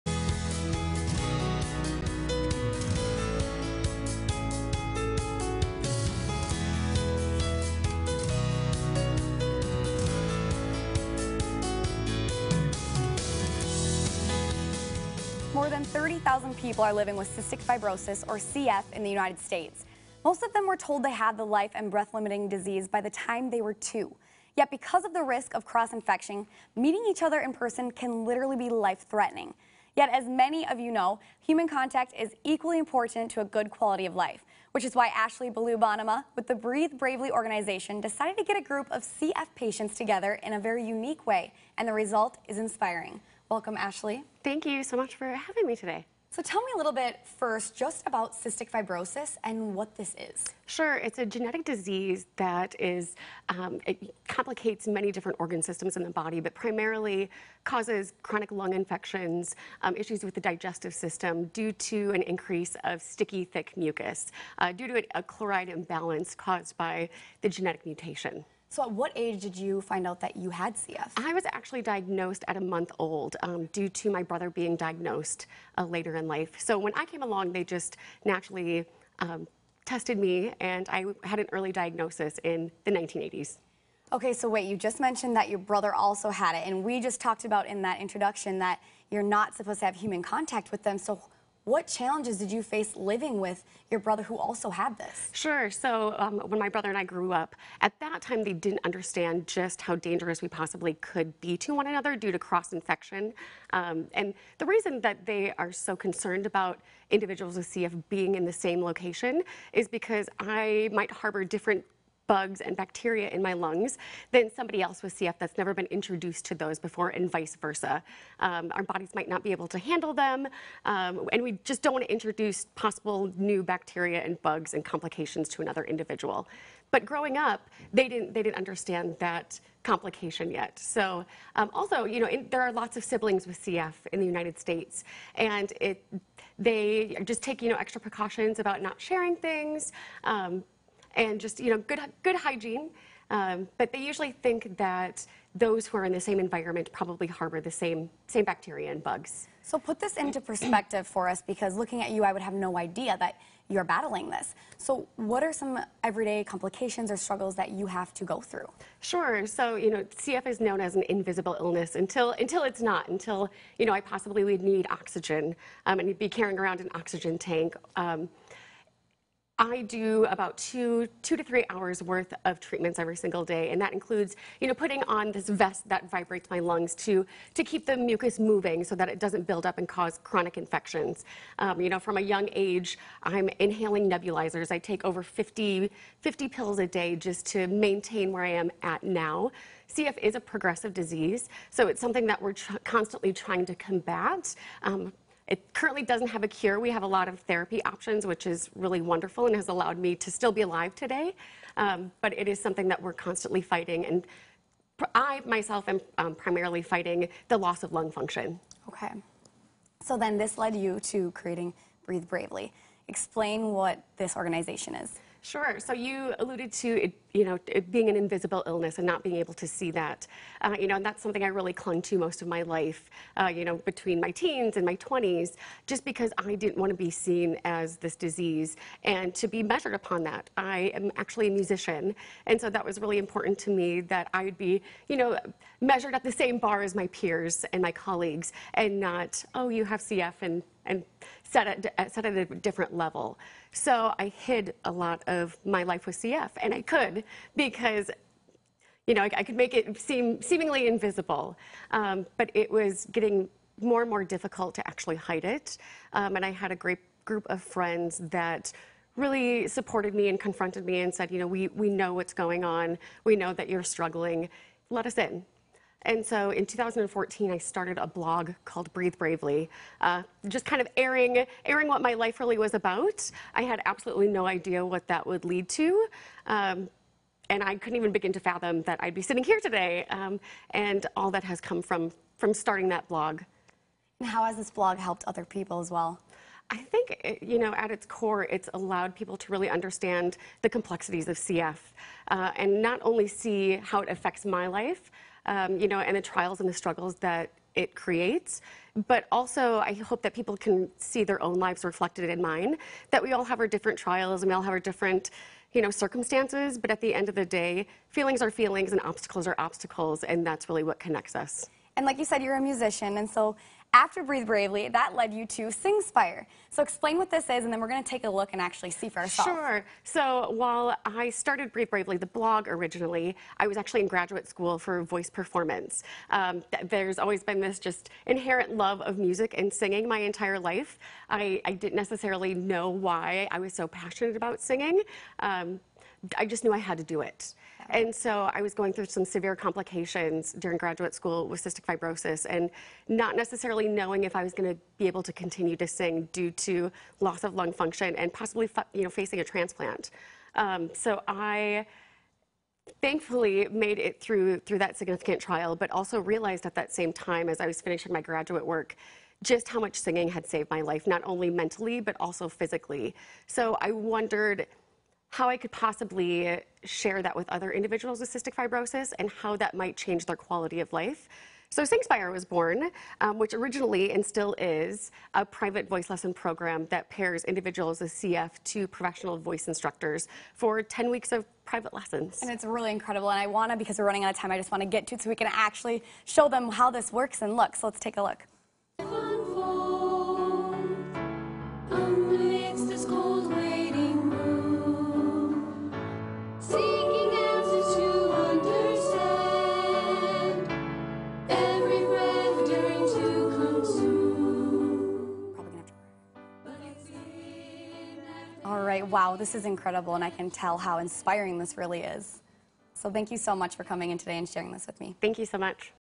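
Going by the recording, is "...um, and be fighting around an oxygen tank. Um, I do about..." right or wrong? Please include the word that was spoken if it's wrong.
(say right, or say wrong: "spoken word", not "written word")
wrong: "carrying", not "fighting".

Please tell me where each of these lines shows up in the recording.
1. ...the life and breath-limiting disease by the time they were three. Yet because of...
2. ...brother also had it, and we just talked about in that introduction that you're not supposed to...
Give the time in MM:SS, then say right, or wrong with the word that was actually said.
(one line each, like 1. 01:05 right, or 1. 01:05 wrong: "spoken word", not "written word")
1. 00:21 wrong: "two", not "three"
2. 01:25 right.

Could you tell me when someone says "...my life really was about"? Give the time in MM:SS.
04:32.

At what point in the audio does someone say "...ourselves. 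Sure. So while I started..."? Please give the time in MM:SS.
05:19.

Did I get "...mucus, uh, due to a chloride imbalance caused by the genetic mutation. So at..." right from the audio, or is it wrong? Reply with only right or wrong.
right.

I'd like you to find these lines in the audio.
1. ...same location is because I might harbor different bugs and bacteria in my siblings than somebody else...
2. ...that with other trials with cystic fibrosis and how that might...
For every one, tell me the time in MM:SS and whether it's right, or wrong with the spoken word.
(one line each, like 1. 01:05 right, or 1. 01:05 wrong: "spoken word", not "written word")
1. 01:48 wrong: "lungs", not "siblings"
2. 06:07 wrong: "individuals", not "trials".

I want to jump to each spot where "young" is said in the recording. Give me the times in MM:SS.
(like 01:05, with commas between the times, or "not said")
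03:02.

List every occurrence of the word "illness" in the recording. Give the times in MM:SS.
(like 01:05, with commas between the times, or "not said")
02:41, 03:38.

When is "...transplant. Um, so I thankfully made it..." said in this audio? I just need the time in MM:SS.
05:49.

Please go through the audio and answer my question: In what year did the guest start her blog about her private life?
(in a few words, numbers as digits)
2014.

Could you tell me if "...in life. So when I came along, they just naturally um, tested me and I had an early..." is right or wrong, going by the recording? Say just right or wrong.
right.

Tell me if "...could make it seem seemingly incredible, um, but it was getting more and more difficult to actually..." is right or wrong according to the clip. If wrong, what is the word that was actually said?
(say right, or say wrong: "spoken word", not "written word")
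wrong: "invisible", not "incredible".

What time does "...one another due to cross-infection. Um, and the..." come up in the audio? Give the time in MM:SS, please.
01:41.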